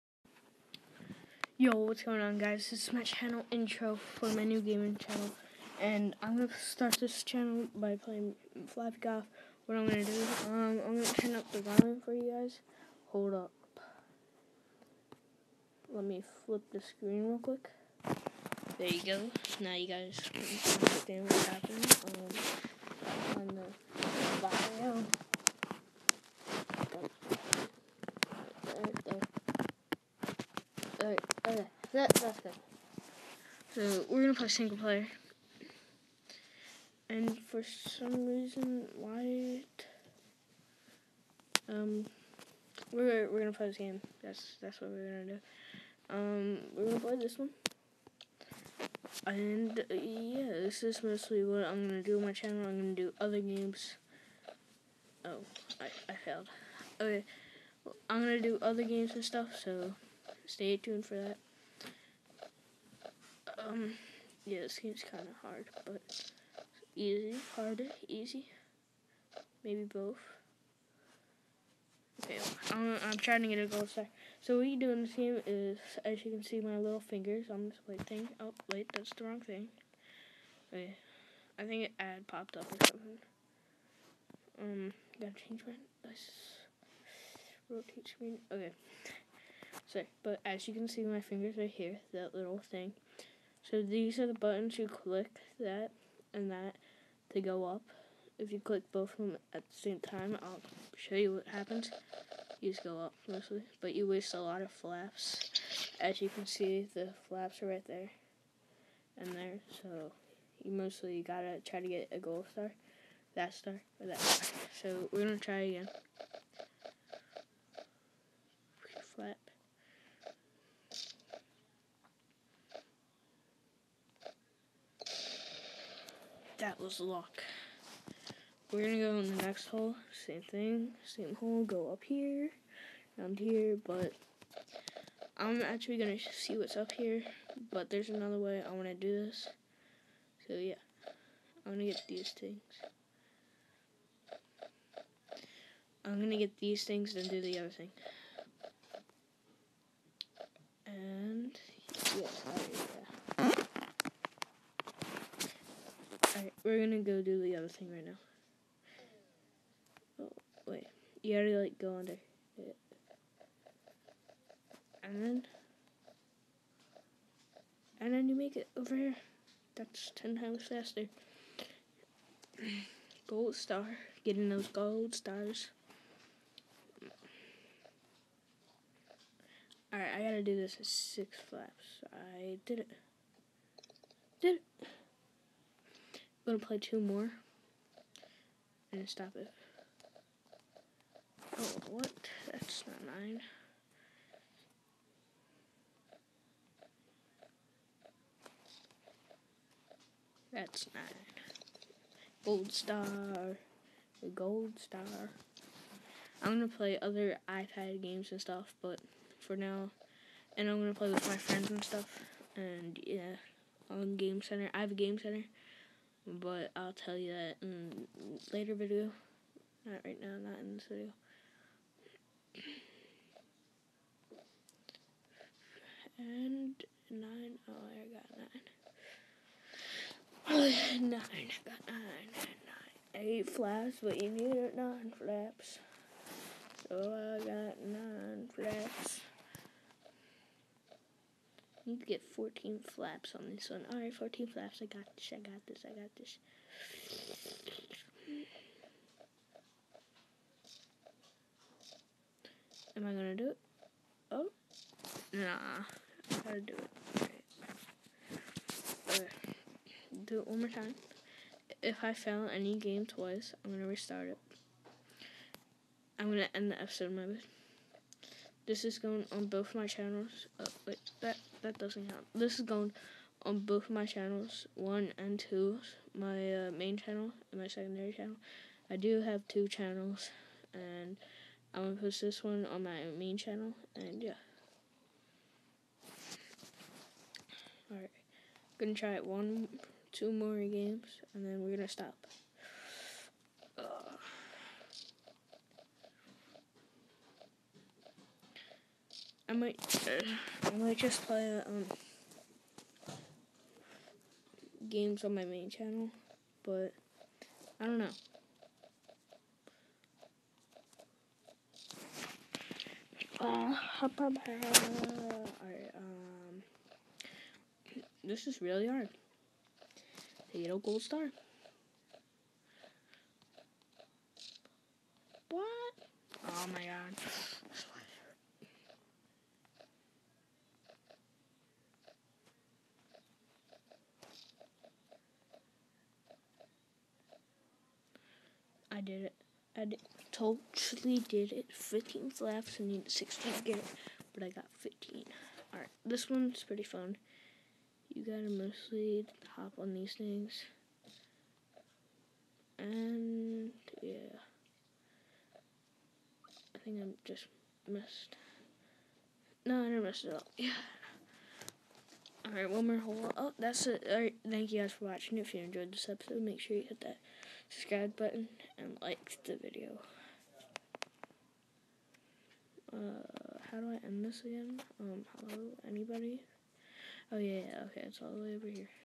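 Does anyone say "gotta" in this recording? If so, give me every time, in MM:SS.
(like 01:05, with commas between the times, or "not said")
01:25, 01:51, 02:41, 03:00, 04:16, 05:48.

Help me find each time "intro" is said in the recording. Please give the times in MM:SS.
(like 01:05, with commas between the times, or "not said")
00:03.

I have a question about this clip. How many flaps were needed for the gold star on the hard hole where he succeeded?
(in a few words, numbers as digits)
16.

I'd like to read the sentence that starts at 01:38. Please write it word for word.
If you click both of them at the same time, I'll show you what happens.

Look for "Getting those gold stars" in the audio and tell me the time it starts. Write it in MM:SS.
02:54.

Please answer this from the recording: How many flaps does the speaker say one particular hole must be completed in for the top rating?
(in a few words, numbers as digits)
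6.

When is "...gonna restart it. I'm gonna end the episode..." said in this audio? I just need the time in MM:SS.
04:23.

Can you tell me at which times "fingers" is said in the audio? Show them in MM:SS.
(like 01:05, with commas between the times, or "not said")
01:16, 01:31.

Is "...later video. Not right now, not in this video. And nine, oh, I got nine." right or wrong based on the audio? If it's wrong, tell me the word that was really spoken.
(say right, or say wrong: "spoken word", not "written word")
right.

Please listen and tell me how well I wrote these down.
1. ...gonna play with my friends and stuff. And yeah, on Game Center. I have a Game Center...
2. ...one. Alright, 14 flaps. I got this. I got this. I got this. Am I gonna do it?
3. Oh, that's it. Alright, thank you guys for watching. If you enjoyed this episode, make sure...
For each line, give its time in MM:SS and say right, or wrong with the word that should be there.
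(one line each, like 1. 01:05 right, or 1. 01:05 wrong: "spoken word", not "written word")
1. 03:30 right
2. 04:03 right
3. 06:03 right.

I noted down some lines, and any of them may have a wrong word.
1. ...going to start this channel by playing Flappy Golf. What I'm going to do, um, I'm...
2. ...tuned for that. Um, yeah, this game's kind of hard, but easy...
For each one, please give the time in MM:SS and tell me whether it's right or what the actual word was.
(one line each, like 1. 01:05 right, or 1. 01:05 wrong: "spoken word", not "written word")
1. 00:06 right
2. 01:00 right.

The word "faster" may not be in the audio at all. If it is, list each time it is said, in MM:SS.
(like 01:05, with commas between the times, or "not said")
02:50.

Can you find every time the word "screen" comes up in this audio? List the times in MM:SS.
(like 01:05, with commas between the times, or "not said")
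00:16, 01:28.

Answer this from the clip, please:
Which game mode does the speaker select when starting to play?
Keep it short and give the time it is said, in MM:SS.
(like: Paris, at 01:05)
Single player, at 00:34.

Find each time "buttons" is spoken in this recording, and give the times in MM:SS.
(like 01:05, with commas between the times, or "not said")
01:34, 06:08.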